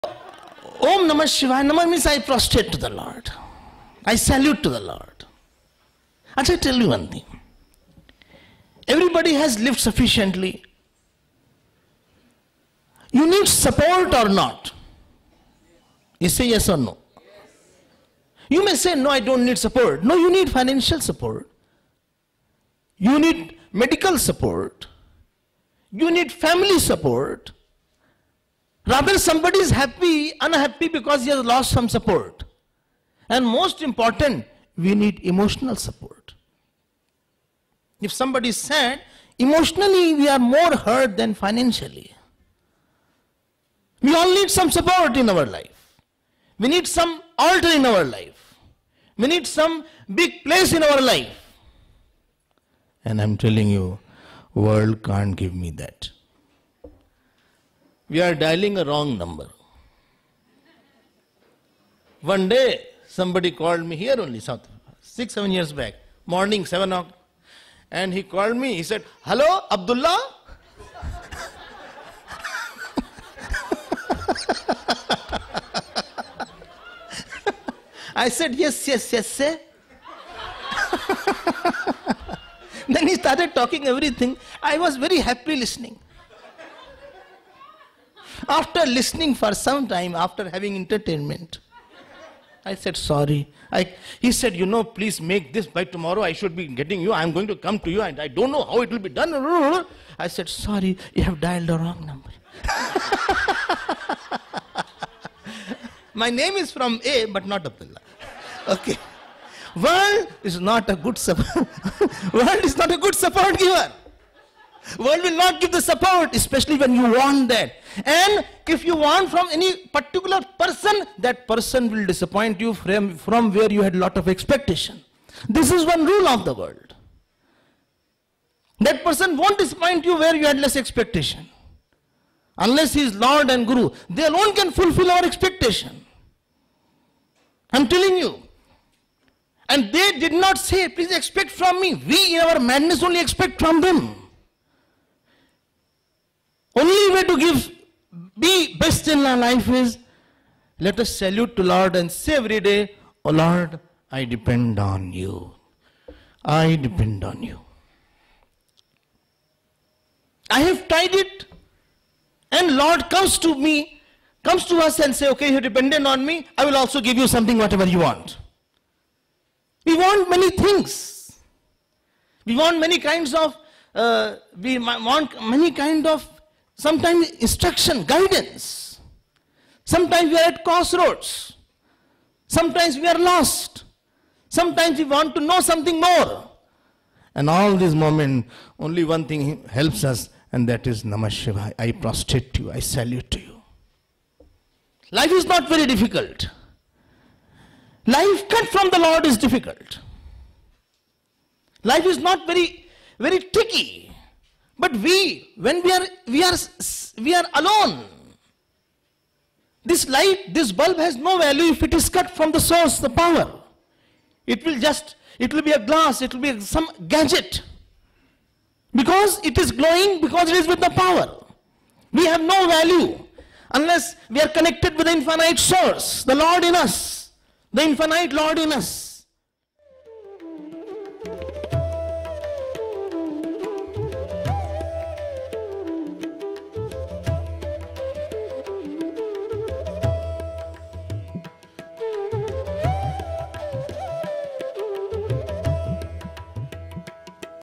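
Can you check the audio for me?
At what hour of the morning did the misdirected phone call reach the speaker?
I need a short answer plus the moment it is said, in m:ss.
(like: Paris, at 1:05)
7 o'clock, at 1:06.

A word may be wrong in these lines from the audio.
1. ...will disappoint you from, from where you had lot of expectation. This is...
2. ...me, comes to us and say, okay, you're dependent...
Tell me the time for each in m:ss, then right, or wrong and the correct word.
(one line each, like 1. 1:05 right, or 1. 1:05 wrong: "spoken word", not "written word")
1. 2:01 right
2. 2:43 right.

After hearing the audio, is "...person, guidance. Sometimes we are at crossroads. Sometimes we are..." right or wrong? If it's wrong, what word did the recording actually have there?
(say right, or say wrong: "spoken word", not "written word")
wrong: "instruction", not "person".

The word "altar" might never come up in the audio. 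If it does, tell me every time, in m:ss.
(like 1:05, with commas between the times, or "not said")
0:47.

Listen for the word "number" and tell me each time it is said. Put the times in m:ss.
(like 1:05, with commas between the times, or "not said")
0:59, 1:42.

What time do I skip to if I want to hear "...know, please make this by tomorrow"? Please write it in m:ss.
1:34.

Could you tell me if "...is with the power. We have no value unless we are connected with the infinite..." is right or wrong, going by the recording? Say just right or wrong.
right.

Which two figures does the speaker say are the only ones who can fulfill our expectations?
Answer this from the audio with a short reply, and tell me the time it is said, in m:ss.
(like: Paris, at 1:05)
Lord and Guru, at 2:13.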